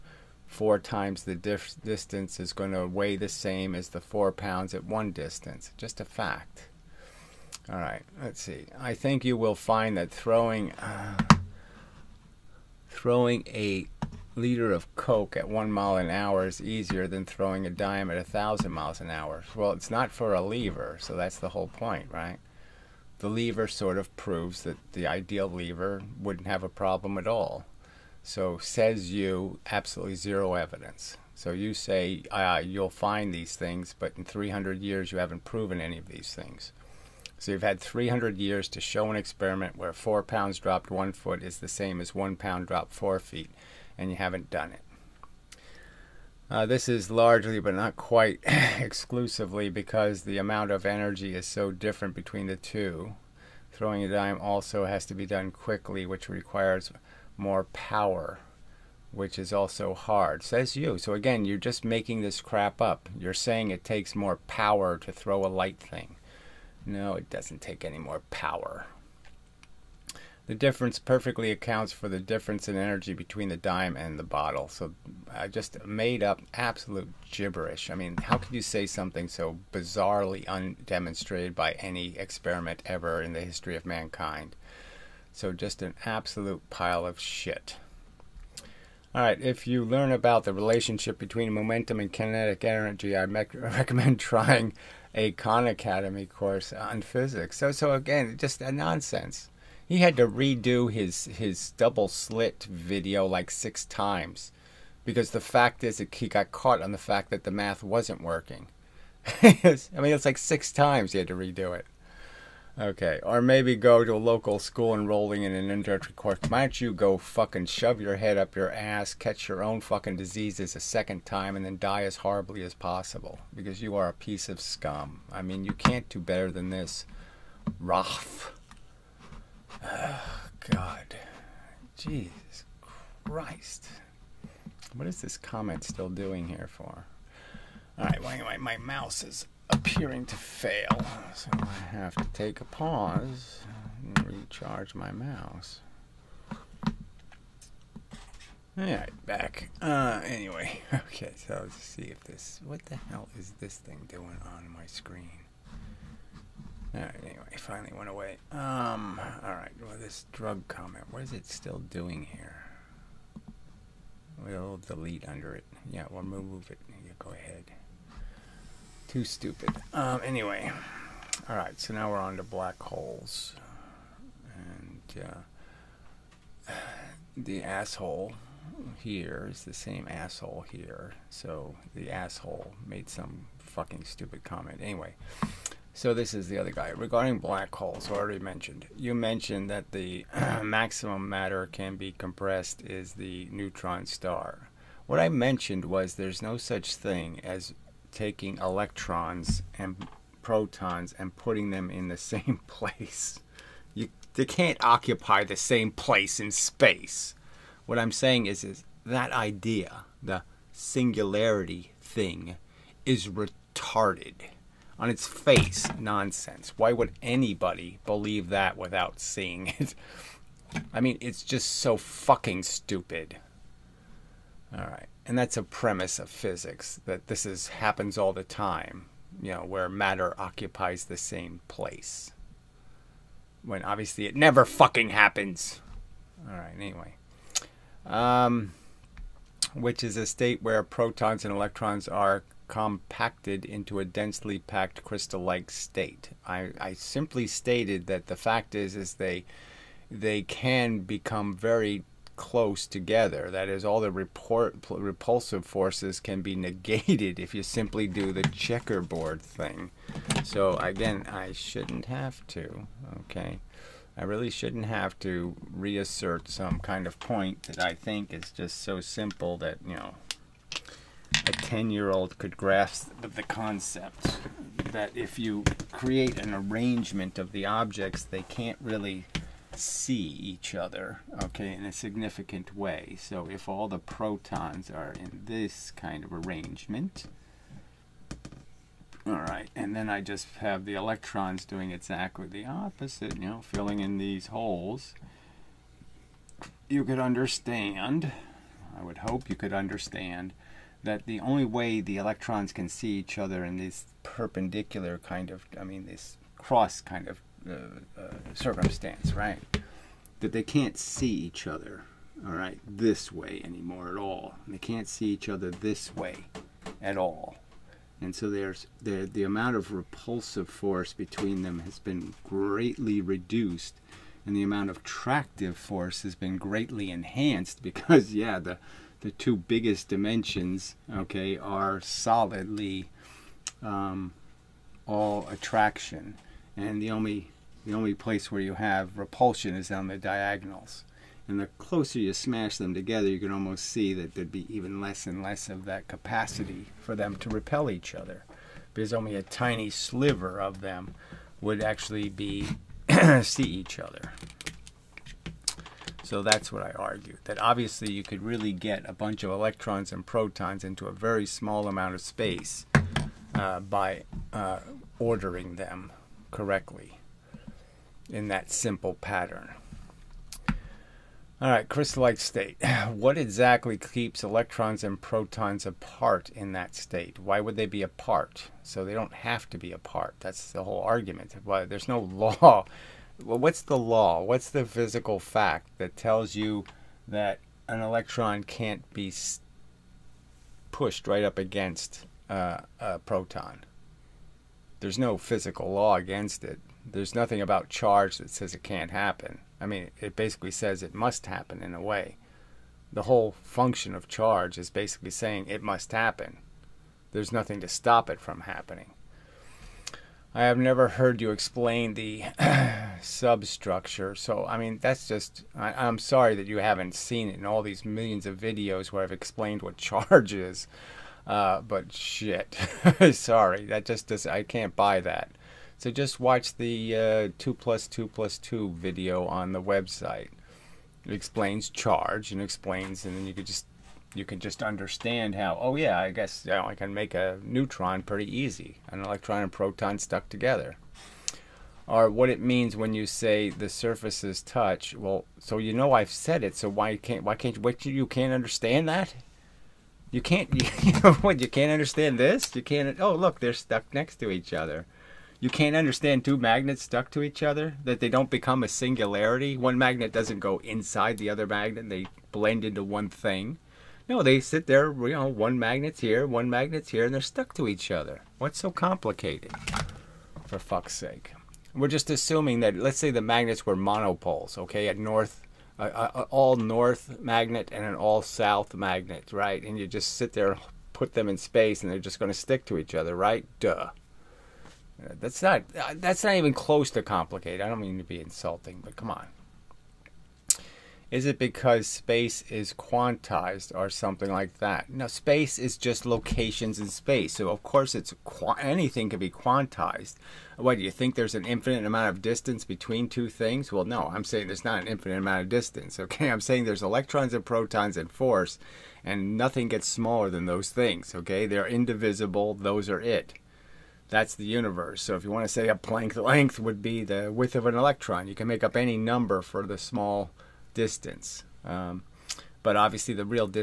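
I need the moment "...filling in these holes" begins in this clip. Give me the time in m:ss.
4:53.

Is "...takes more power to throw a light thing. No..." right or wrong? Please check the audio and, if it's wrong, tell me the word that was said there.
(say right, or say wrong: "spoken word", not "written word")
right.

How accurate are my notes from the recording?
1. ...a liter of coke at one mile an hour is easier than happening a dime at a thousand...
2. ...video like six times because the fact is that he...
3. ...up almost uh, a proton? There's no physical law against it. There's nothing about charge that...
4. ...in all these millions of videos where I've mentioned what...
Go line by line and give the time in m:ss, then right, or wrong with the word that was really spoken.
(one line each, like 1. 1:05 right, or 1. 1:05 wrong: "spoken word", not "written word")
1. 0:13 wrong: "throwing", not "happening"
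2. 1:42 right
3. 6:31 wrong: "against", not "almost"
4. 6:57 wrong: "explained", not "mentioned".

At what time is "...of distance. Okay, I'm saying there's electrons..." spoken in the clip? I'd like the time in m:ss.
8:25.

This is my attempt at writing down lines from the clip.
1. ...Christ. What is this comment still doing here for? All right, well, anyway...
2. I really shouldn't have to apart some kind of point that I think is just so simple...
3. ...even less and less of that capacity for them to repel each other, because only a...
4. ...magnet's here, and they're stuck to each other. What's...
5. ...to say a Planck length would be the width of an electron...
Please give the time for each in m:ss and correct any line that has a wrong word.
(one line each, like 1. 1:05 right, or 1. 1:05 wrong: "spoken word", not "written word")
1. 2:13 right
2. 4:24 wrong: "reassert", not "apart"
3. 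5:44 right
4. 7:46 right
5. 8:35 right.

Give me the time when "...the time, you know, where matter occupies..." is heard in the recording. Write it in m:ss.
3:48.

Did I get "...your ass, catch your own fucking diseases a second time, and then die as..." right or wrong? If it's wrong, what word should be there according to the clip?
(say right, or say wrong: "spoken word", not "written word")
right.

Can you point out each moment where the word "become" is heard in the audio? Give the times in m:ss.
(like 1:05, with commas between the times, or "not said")
4:10, 7:38.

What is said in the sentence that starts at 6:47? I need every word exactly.
There's nothing to stop it from happening.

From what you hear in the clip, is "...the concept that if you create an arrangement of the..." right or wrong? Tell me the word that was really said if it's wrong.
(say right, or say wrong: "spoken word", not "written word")
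right.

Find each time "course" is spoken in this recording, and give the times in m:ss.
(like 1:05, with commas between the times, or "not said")
1:36, 1:56, 8:17.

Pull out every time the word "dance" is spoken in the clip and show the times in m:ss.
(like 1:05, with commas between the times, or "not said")
not said.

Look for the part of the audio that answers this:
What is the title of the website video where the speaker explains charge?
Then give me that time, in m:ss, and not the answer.
7:07.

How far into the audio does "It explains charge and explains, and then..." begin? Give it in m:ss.
7:11.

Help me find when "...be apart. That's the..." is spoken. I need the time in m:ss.
6:19.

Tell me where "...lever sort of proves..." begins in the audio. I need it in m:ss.
0:23.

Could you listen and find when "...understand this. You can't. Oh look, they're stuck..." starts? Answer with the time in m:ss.
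7:31.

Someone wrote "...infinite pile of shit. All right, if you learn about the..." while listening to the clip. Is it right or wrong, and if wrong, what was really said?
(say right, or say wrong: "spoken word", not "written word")
wrong: "absolute", not "infinite".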